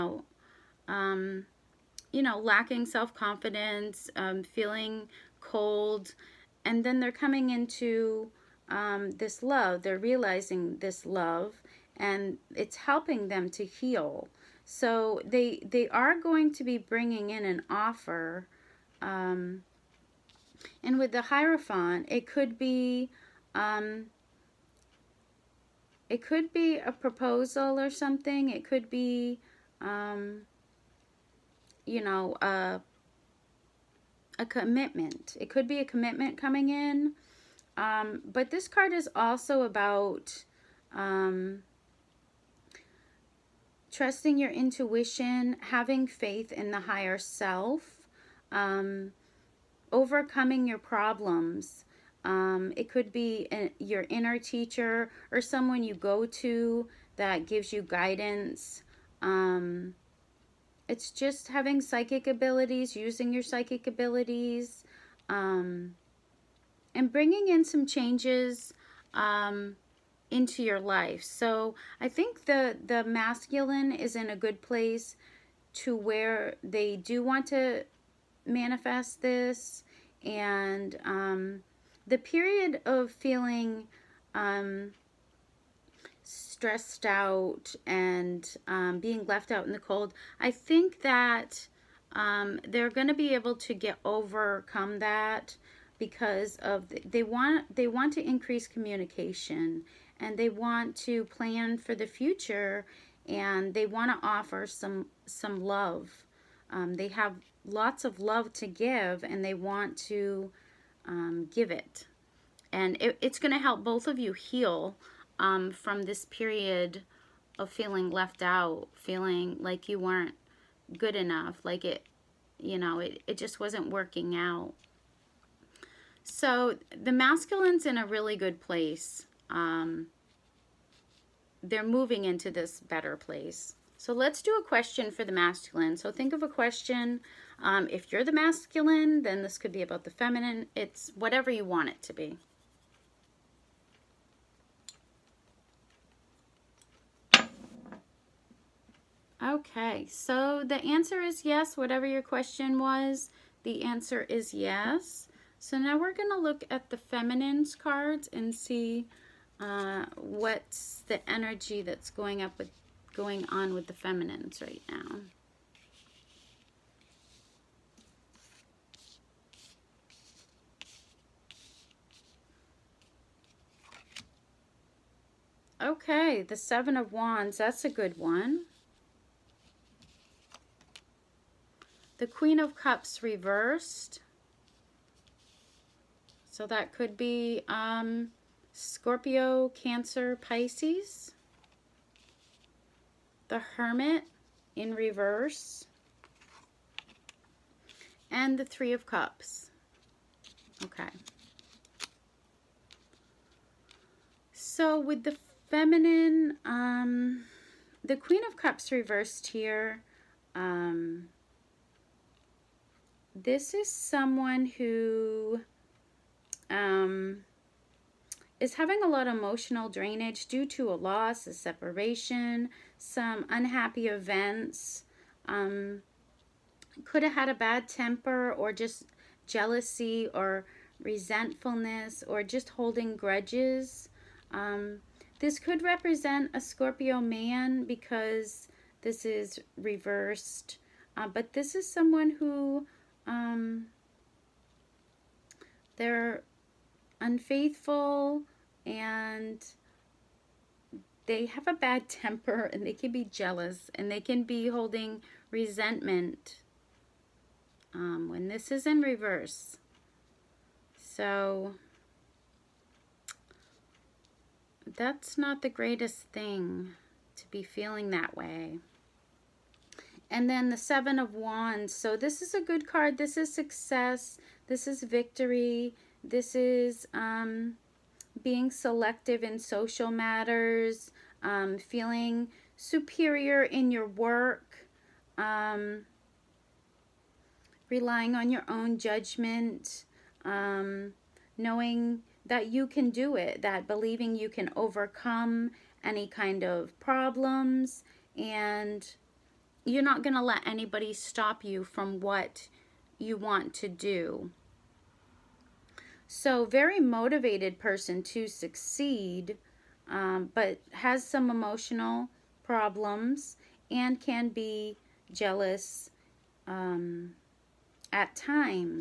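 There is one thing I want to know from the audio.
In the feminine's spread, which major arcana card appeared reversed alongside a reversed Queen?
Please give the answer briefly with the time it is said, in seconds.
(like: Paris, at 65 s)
The Hermit, at 193 s.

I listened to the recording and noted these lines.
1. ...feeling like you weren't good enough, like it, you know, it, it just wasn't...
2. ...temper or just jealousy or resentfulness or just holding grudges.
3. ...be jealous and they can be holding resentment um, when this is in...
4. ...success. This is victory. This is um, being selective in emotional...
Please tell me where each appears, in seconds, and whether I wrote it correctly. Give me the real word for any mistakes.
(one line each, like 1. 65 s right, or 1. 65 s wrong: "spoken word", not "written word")
1. 118 s right
2. 227 s right
3. 253 s right
4. 273 s wrong: "social", not "emotional".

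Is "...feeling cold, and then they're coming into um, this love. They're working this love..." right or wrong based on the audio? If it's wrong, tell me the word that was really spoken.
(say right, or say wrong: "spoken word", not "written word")
wrong: "realizing", not "working".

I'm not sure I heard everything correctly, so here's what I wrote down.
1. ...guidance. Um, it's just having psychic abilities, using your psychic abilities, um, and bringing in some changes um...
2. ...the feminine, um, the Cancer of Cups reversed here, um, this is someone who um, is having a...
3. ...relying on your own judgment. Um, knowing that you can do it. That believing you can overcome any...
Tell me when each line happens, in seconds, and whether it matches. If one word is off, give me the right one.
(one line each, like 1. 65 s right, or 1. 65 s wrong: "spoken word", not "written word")
1. 57 s right
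2. 205 s wrong: "Queen", not "Cancer"
3. 287 s right.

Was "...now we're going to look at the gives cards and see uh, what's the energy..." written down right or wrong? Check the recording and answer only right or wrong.
wrong.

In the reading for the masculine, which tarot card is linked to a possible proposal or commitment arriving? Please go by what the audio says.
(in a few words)
The Hierophant.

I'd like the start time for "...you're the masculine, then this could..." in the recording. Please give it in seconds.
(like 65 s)
138 s.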